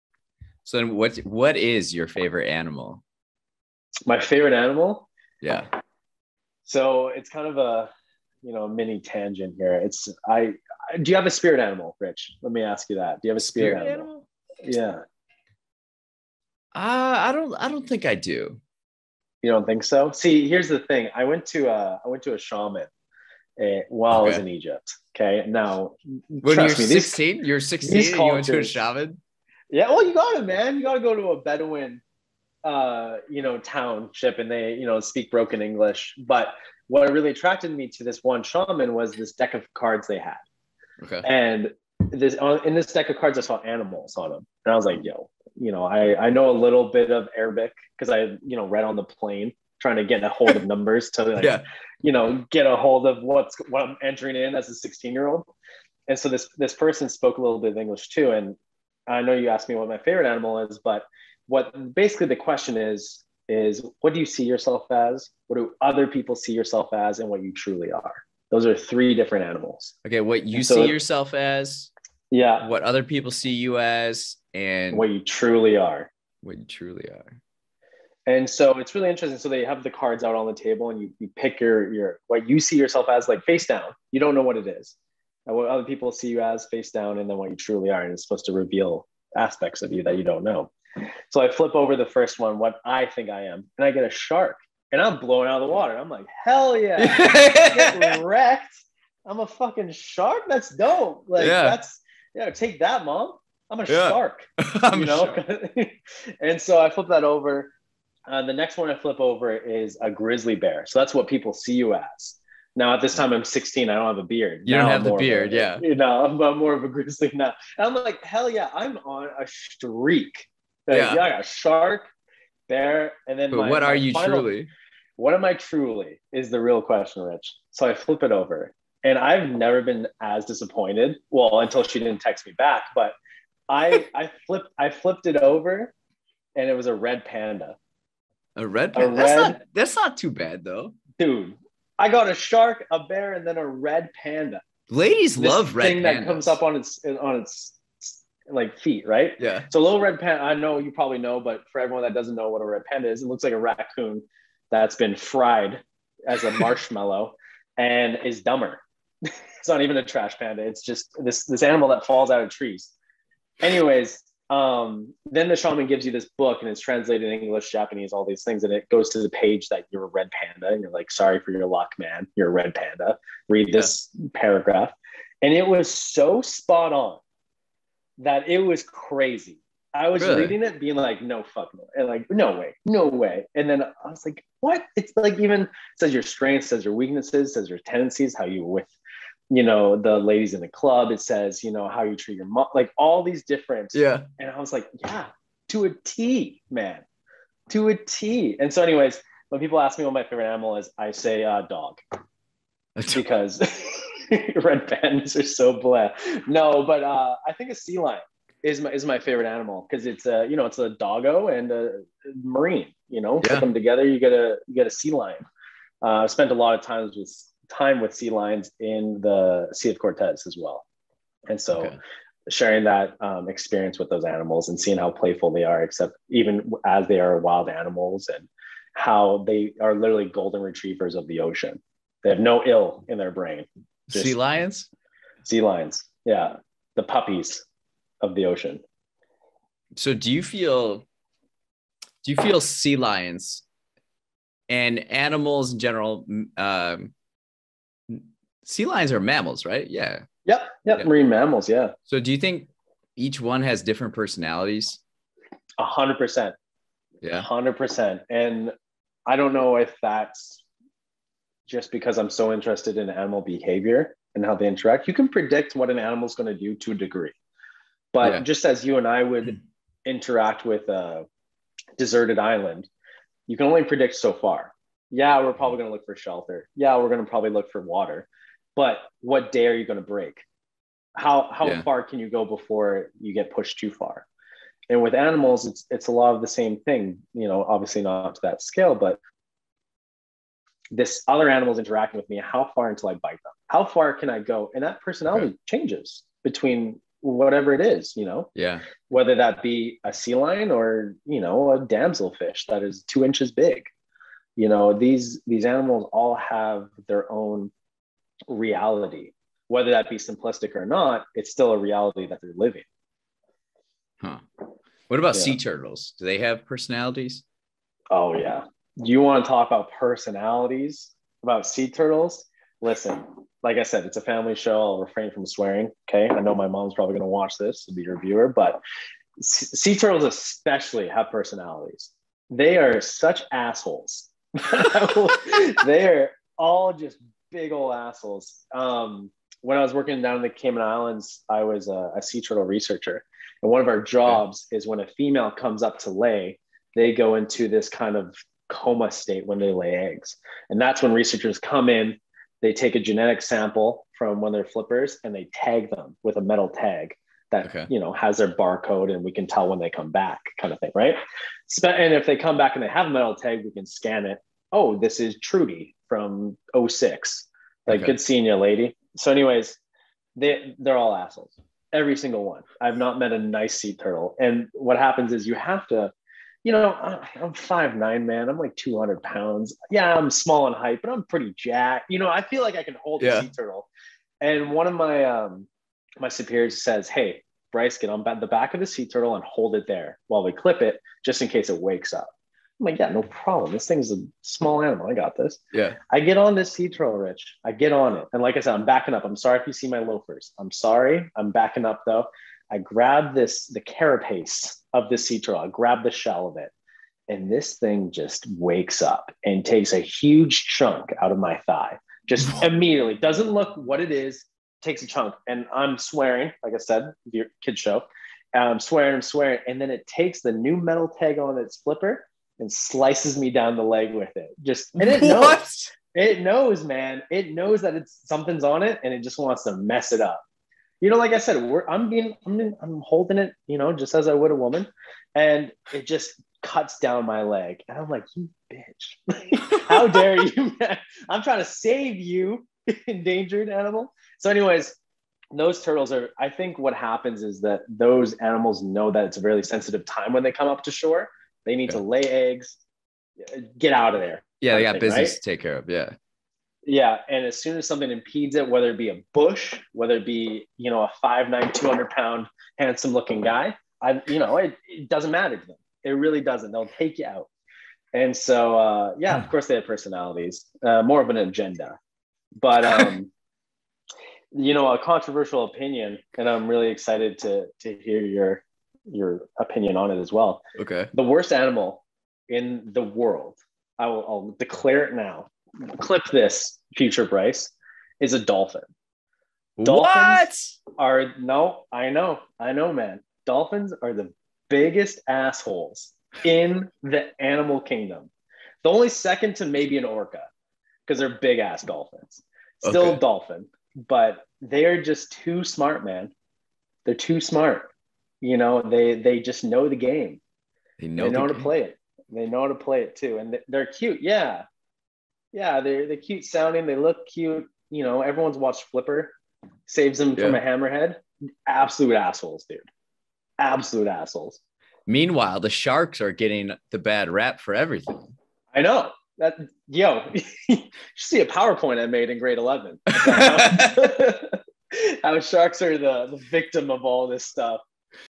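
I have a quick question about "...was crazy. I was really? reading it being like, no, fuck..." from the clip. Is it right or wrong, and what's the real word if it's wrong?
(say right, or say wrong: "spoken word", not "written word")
right.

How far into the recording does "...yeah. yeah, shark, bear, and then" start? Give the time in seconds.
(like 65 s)
120 s.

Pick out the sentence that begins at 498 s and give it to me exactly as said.
The only second to maybe an orca, because they're big ass dolphins.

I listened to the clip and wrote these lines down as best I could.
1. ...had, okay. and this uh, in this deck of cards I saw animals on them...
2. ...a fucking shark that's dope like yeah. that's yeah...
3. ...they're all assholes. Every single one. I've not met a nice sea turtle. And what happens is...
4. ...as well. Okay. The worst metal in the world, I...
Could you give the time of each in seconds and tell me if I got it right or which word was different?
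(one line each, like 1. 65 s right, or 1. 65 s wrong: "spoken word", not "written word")
1. 40 s right
2. 99 s right
3. 370 s right
4. 480 s wrong: "animal", not "metal".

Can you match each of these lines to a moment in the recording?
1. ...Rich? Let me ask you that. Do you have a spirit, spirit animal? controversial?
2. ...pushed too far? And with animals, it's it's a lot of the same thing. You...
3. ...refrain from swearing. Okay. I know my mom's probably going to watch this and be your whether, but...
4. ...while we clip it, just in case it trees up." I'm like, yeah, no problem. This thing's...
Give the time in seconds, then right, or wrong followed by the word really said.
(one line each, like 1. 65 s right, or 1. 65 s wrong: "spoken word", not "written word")
1. 11 s wrong: "animal", not "controversial"
2. 283 s right
3. 325 s wrong: "viewer", not "whether"
4. 390 s wrong: "wakes", not "trees".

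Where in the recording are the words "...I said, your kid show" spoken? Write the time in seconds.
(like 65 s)
416 s.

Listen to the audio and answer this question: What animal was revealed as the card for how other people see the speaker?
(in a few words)
Grizzly bear.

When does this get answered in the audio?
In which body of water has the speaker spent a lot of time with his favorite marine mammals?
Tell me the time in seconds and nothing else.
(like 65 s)
219 s.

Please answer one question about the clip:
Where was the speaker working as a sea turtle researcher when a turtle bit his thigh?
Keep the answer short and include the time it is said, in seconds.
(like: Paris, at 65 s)
Cayman Islands, at 340 s.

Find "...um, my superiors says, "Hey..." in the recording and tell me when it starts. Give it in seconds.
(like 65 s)
385 s.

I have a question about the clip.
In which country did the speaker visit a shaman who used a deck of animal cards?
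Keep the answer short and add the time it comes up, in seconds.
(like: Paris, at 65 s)
Egypt, at 24 s.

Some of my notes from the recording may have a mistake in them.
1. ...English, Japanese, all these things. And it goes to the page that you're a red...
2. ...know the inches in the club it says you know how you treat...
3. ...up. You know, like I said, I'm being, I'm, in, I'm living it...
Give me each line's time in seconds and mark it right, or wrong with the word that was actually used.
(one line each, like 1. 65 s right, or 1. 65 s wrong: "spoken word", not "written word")
1. 167 s right
2. 189 s wrong: "ladies", not "inches"
3. 430 s wrong: "holding", not "living".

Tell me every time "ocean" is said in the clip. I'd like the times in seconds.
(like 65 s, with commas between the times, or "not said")
231 s, 238 s.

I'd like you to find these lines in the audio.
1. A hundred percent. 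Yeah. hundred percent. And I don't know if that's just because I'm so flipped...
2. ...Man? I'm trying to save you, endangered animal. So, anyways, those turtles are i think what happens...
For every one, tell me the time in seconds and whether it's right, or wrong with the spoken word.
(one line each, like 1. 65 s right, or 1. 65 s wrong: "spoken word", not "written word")
1. 255 s wrong: "interested", not "flipped"
2. 440 s right.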